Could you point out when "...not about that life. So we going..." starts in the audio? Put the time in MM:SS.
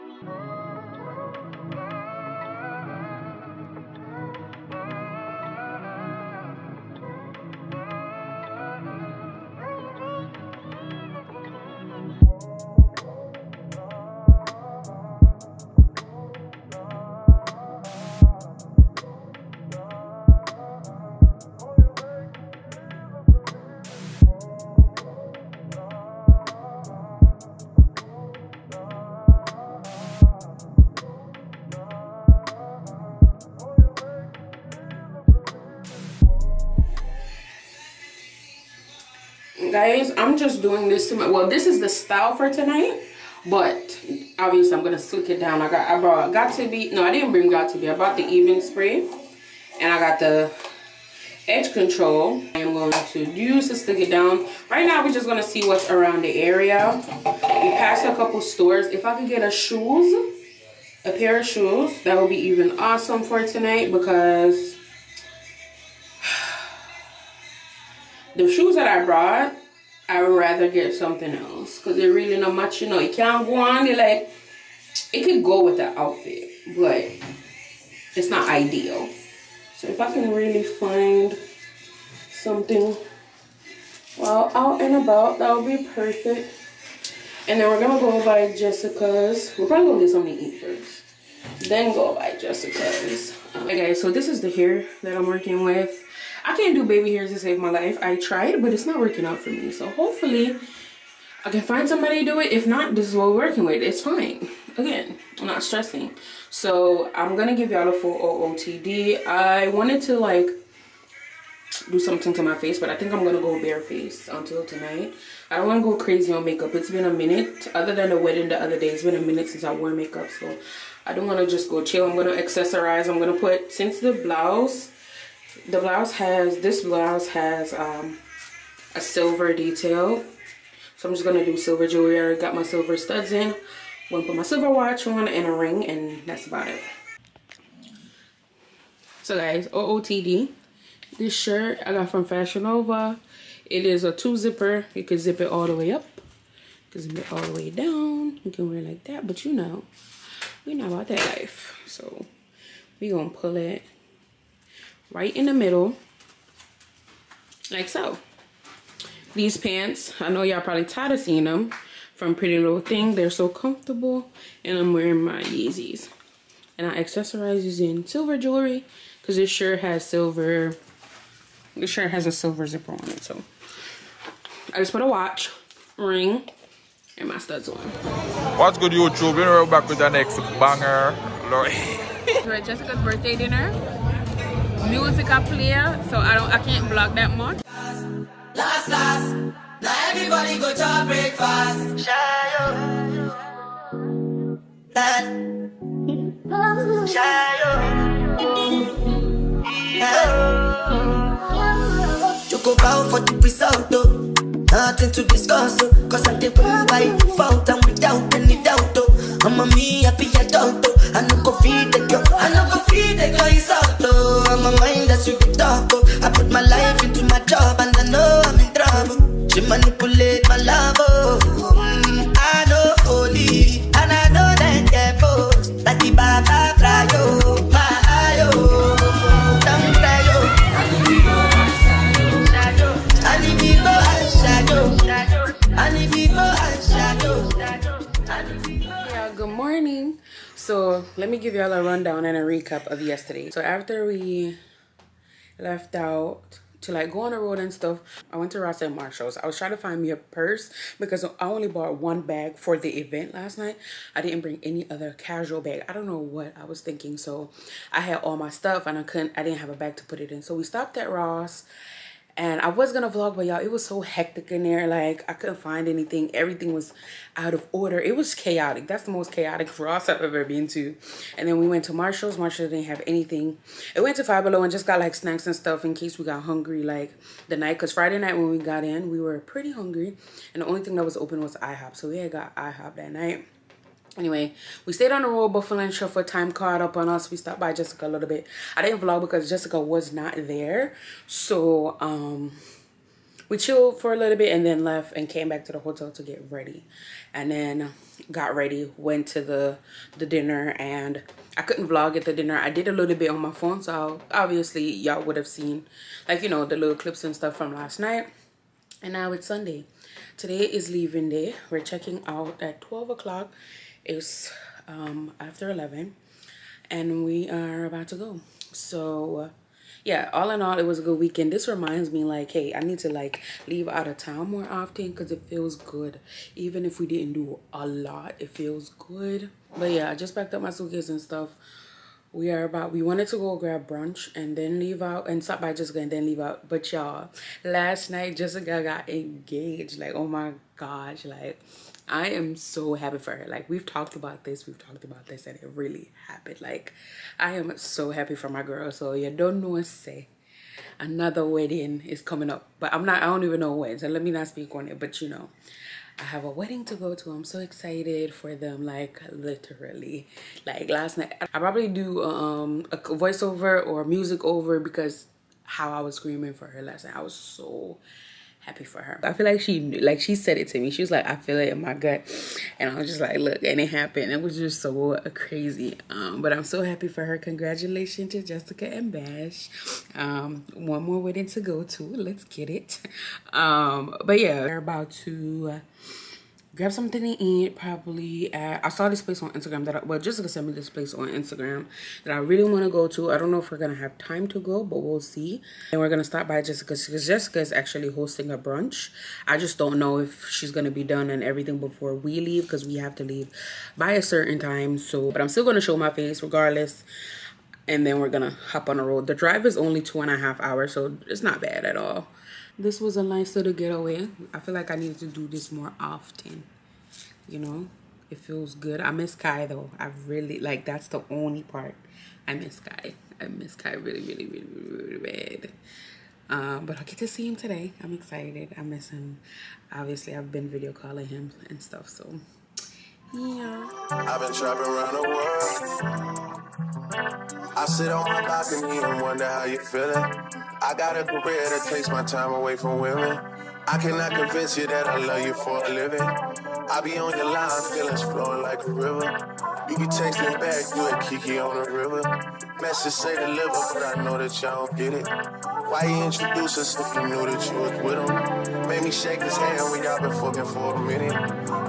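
02:30.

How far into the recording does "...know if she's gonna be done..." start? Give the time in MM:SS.
06:39.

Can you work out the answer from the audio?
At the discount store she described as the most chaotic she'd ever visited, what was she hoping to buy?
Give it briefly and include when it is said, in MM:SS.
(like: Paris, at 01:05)
a purse, at 04:10.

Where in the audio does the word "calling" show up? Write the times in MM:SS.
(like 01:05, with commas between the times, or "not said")
07:10.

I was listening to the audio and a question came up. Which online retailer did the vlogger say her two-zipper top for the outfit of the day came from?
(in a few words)
Fashion Nova.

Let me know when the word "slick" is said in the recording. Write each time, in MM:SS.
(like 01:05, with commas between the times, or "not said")
00:44, 00:53.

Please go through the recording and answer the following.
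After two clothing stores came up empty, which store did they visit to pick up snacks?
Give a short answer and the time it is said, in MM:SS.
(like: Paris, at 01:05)
Five Below, at 04:34.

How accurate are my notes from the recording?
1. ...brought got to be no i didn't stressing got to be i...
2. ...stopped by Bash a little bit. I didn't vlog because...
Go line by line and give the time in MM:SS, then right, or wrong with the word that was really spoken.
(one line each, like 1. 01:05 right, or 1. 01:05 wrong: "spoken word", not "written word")
1. 00:45 wrong: "bring", not "stressing"
2. 04:47 wrong: "Jessica", not "Bash".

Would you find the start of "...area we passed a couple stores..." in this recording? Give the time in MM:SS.
00:56.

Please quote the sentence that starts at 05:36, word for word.
But y'all, last night Jessica got engaged.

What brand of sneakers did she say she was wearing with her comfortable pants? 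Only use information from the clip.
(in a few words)
Yeezys.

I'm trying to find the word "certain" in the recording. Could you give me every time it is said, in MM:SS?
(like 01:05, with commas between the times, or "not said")
06:44.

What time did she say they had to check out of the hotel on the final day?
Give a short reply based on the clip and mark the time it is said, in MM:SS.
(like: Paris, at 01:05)
12 o'clock, at 05:12.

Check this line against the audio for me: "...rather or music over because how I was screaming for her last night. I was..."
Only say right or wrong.
wrong.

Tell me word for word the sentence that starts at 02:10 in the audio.
So I'm just going to do silver jewelry.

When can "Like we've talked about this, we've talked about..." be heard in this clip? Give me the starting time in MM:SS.
05:43.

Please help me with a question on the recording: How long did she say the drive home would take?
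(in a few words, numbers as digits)
2 and a half hours.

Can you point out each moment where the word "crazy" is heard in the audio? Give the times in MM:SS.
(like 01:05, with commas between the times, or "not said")
01:56, 06:15.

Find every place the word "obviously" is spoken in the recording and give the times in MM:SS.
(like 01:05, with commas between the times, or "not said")
00:44, 05:04, 07:09.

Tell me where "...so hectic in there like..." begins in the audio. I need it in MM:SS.
04:23.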